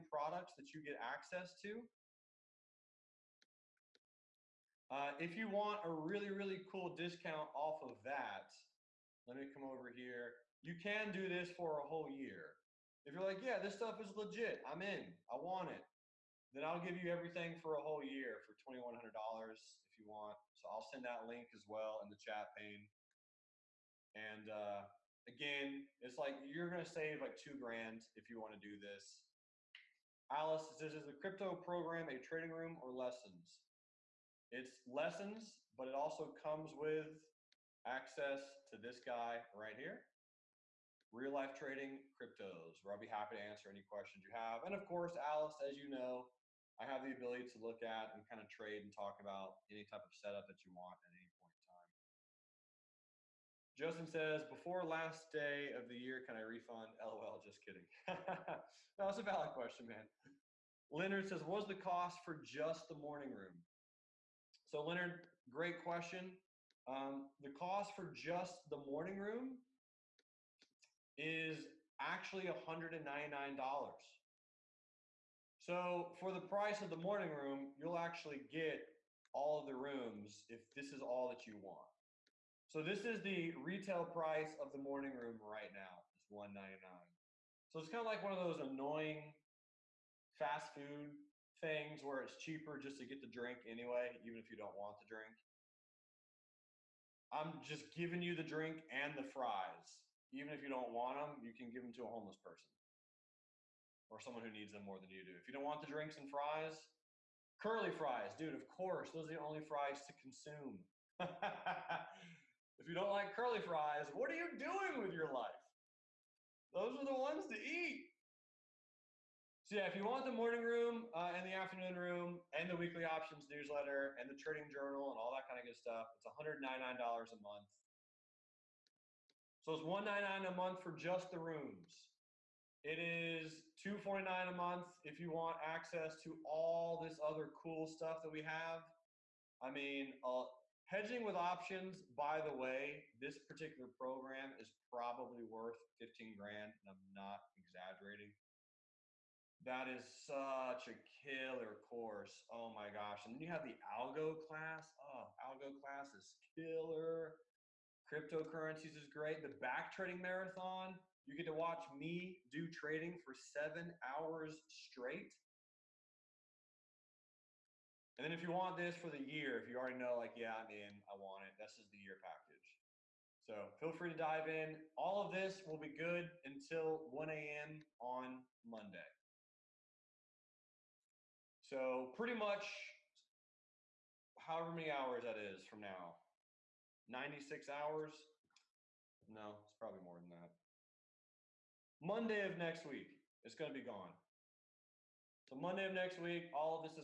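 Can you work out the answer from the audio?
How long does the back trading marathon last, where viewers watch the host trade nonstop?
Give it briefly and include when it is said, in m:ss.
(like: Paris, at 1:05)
7 hours, at 2:43.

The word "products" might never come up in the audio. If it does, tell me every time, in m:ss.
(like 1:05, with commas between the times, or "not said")
0:00.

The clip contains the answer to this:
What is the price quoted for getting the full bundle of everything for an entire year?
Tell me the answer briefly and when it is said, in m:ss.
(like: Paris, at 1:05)
$2,100, at 0:18.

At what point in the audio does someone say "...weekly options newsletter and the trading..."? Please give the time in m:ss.
2:02.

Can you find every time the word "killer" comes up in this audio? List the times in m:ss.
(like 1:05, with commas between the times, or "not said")
2:31, 2:36.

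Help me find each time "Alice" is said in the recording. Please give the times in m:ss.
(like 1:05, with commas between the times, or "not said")
0:30, 0:45.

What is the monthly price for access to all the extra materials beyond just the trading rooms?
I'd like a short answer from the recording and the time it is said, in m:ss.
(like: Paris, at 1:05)
$249, at 2:13.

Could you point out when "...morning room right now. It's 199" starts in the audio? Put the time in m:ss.
1:24.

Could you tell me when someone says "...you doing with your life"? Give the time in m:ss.
1:54.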